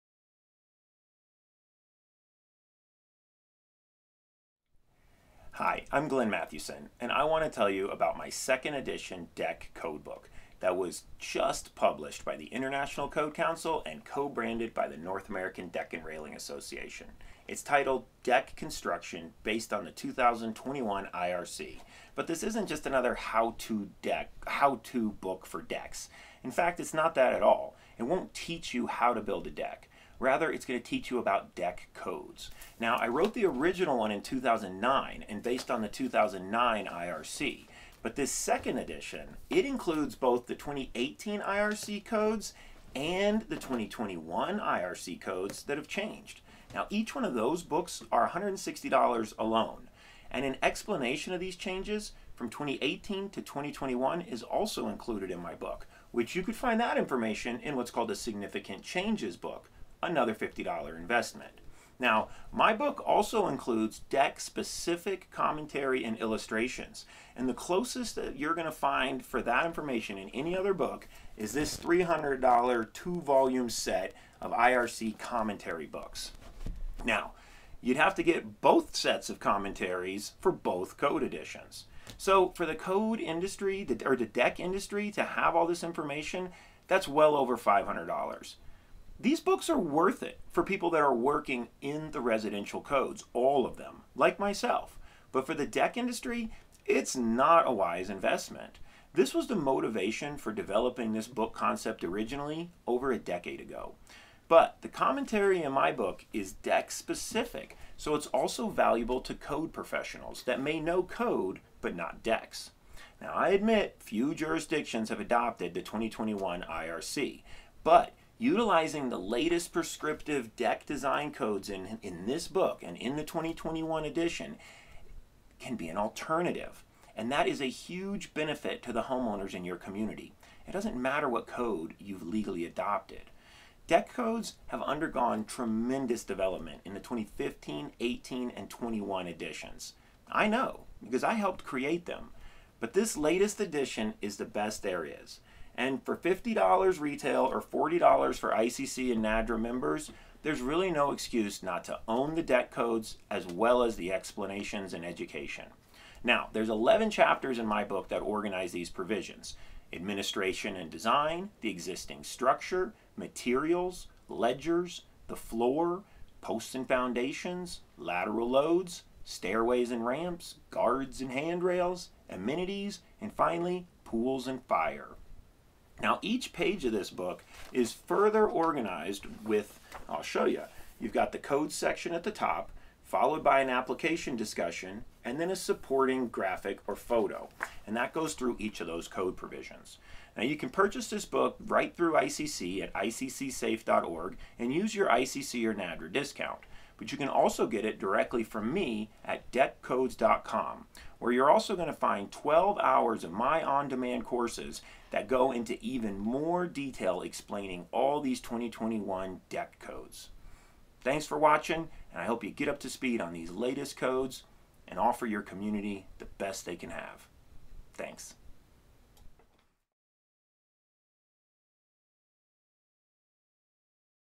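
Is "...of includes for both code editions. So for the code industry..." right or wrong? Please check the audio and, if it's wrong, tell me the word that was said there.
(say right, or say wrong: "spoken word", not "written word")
wrong: "commentaries", not "includes".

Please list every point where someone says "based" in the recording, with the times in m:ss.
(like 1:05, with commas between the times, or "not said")
0:19, 0:35.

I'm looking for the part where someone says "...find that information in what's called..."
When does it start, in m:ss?
0:56.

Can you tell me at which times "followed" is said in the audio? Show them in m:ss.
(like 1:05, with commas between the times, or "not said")
3:03.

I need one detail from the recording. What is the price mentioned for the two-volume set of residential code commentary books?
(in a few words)
$300.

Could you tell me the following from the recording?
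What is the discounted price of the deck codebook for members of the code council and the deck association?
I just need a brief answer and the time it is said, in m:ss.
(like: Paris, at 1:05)
$40, at 2:27.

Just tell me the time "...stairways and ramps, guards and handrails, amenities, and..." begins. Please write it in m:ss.
2:49.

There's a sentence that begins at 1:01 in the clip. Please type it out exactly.
Now, my book also includes deck specific commentary and illustrations.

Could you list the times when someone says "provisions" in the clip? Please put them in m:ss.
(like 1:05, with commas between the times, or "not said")
2:38, 3:09.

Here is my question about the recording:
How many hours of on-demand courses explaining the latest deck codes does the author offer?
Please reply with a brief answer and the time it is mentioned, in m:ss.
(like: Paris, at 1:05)
12, at 3:22.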